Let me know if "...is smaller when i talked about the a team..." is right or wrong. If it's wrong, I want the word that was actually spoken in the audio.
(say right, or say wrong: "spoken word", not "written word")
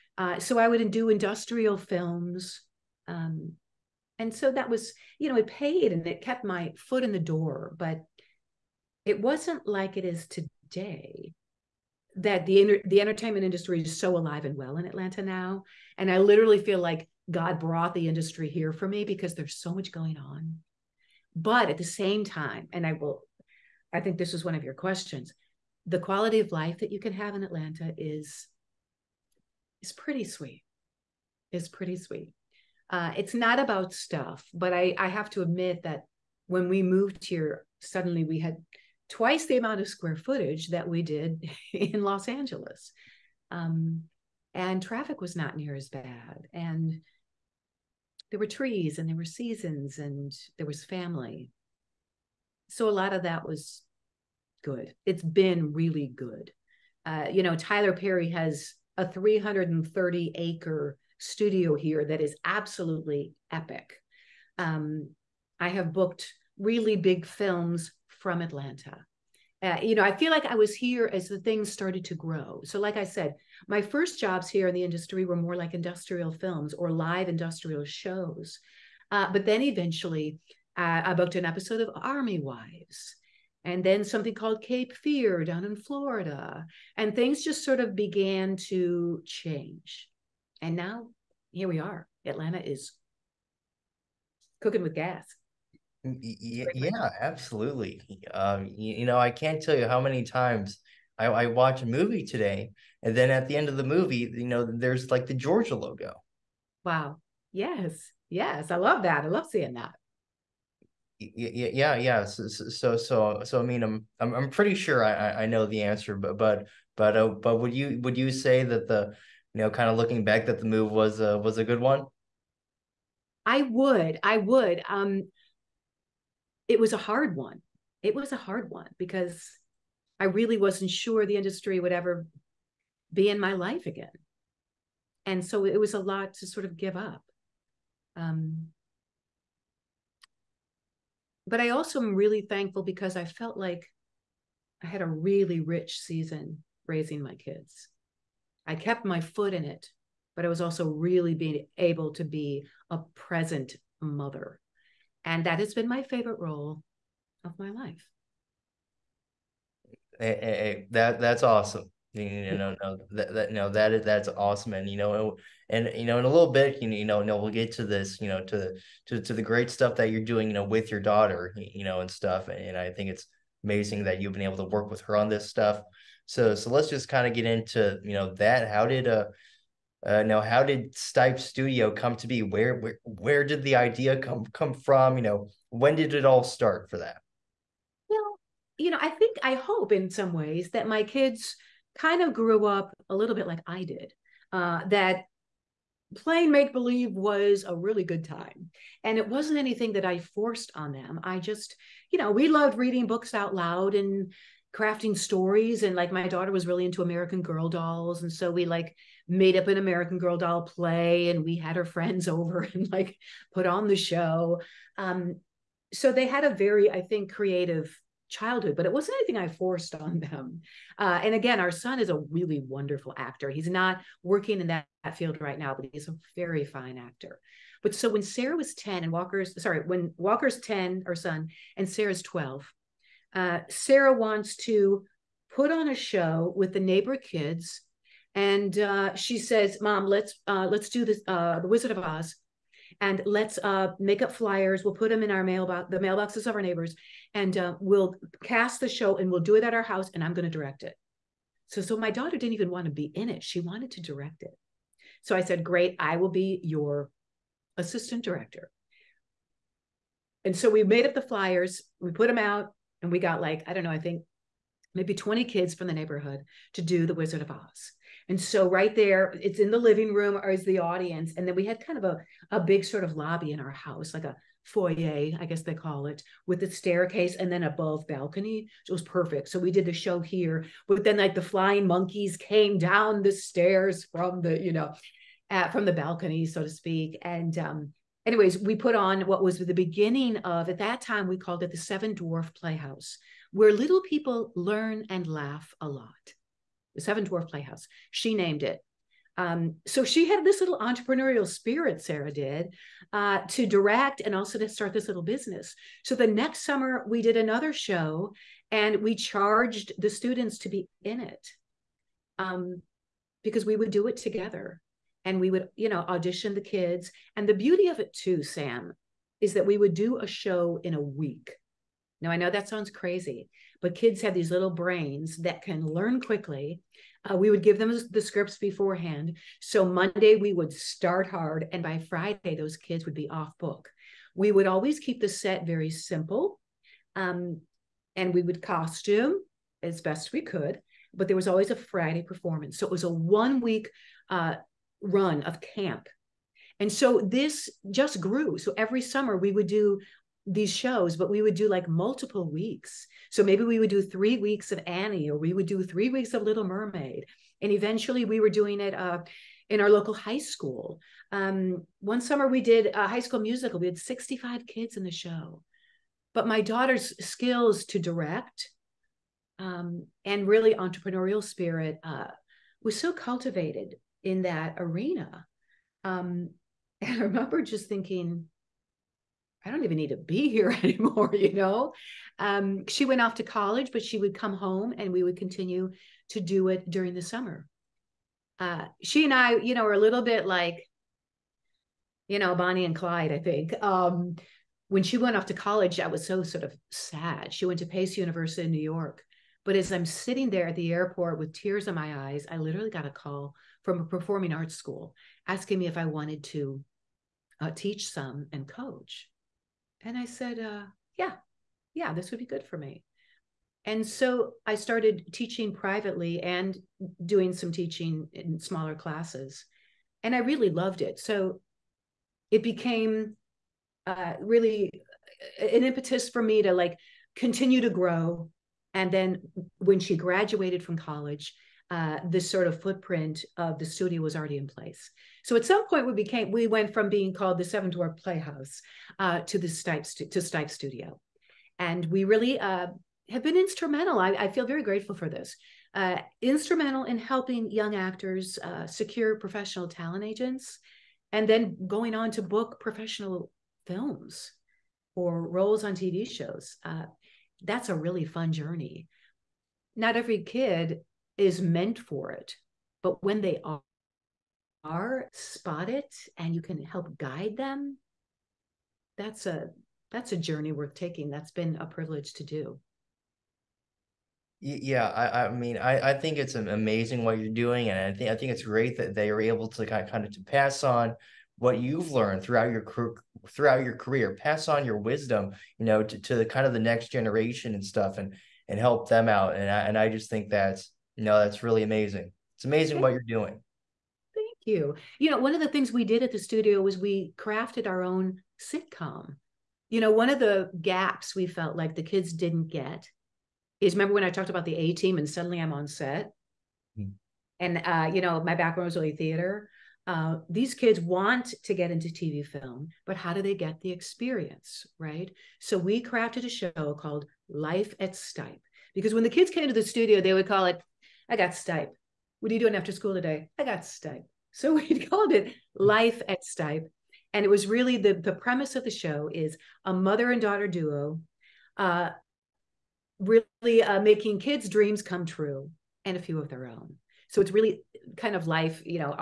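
wrong: "remember", not "smaller".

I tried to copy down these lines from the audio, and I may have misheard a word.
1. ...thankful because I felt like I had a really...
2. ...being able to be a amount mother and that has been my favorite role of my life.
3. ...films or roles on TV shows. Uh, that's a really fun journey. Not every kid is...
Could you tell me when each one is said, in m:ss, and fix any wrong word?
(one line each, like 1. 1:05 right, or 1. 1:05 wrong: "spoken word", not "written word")
1. 2:22 right
2. 2:31 wrong: "present", not "amount"
3. 7:33 right.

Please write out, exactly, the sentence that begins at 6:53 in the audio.
And so I started teaching privately and doing some teaching in smaller classes.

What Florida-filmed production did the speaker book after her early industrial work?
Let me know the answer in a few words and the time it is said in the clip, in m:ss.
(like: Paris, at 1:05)
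Cape Fear, at 1:24.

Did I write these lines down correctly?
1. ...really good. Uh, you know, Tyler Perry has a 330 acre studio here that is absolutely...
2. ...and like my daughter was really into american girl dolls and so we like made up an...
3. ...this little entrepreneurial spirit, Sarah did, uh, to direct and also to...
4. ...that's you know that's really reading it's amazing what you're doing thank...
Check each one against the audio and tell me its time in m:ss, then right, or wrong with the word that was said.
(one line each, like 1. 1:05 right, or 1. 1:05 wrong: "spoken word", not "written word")
1. 0:55 right
2. 3:25 right
3. 5:00 right
4. 8:10 wrong: "amazing", not "reading".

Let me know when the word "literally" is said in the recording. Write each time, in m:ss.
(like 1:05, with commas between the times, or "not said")
0:16, 6:42.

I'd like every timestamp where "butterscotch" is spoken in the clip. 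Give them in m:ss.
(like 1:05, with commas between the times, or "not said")
not said.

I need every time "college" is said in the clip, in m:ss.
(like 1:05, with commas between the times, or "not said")
6:23, 6:35, 7:10.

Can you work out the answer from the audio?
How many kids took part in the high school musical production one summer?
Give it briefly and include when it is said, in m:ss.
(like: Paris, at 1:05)
65, at 6:03.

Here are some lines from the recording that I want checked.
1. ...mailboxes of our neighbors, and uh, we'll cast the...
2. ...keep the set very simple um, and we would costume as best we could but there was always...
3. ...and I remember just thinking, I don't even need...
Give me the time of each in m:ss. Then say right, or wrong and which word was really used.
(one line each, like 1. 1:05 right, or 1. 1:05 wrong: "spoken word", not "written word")
1. 4:05 right
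2. 5:35 right
3. 6:17 right.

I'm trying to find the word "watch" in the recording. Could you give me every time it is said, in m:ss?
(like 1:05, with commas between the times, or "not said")
1:41.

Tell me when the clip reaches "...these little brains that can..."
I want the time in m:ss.
5:24.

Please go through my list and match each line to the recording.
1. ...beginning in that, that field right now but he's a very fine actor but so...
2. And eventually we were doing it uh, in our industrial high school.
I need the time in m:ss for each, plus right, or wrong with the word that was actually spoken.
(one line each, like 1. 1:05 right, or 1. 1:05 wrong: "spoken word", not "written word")
1. 3:44 wrong: "working", not "beginning"
2. 5:57 wrong: "local", not "industrial".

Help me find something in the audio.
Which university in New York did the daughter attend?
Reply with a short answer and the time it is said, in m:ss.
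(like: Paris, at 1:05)
Pace University, at 6:37.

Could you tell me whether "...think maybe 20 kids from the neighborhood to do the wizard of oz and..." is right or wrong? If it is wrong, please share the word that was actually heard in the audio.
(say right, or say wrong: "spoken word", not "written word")
right.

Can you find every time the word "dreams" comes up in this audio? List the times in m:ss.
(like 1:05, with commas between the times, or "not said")
8:54.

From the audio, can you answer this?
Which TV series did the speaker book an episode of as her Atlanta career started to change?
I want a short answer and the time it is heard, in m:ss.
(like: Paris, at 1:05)
Army Wives, at 1:21.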